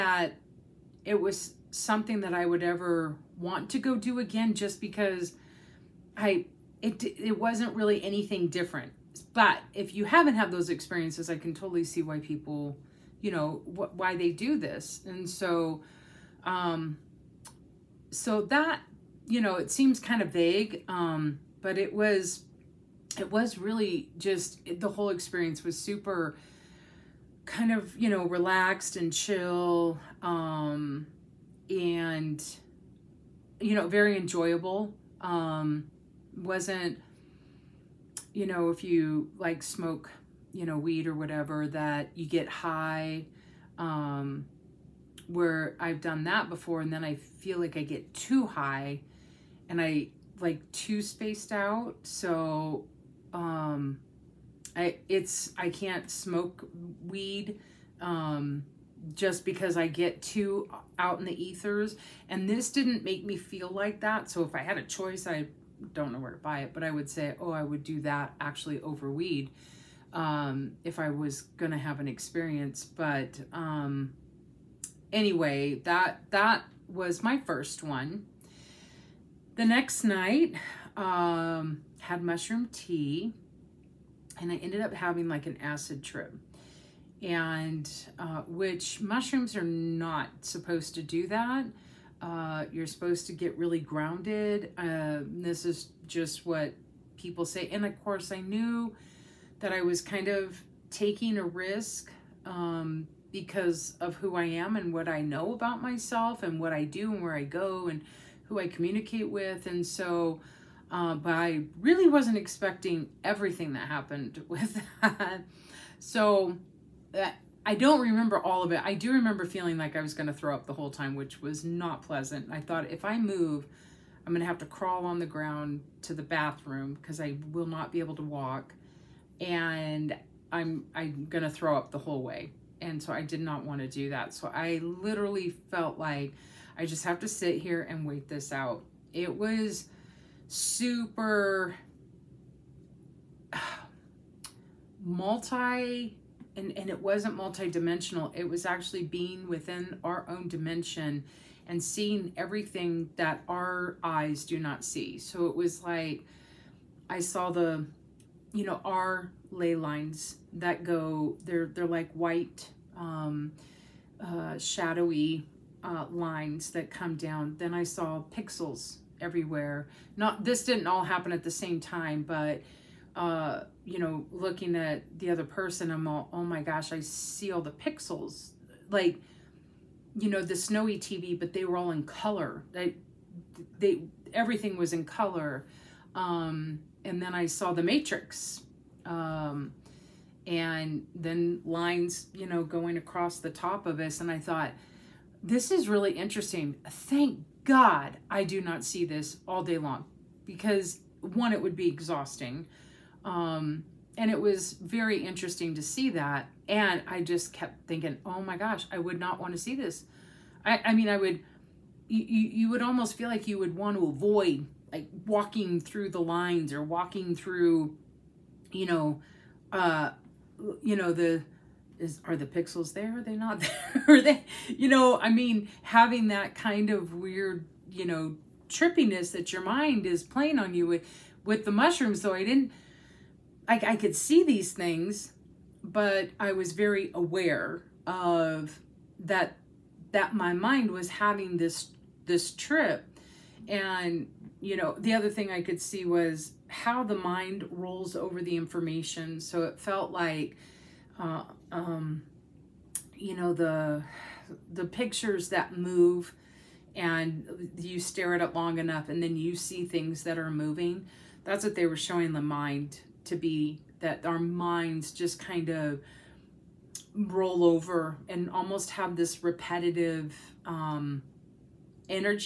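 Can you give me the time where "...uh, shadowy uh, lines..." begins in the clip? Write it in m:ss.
2:44.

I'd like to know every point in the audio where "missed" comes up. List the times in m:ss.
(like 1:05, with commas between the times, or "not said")
not said.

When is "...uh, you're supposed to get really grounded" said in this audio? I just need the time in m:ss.
1:32.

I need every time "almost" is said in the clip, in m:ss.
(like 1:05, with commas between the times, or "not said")
3:32, 4:28.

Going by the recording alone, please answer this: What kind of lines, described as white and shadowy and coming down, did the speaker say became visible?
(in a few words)
ley lines.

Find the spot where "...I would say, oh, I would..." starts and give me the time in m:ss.
1:06.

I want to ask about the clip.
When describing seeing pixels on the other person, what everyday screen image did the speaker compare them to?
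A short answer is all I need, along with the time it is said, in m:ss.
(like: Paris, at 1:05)
snowy TV, at 3:00.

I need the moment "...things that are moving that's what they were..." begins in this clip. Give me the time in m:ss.
4:19.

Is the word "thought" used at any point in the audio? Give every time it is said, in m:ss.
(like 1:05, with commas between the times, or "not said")
2:02, 3:14.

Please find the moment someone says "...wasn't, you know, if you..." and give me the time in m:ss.
0:36.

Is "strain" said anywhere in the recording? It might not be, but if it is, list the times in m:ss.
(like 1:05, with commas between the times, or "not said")
not said.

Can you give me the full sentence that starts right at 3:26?
And I just kept thinking, oh my gosh, I would not want to see this.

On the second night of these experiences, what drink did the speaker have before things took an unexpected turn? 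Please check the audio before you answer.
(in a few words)
mushroom tea.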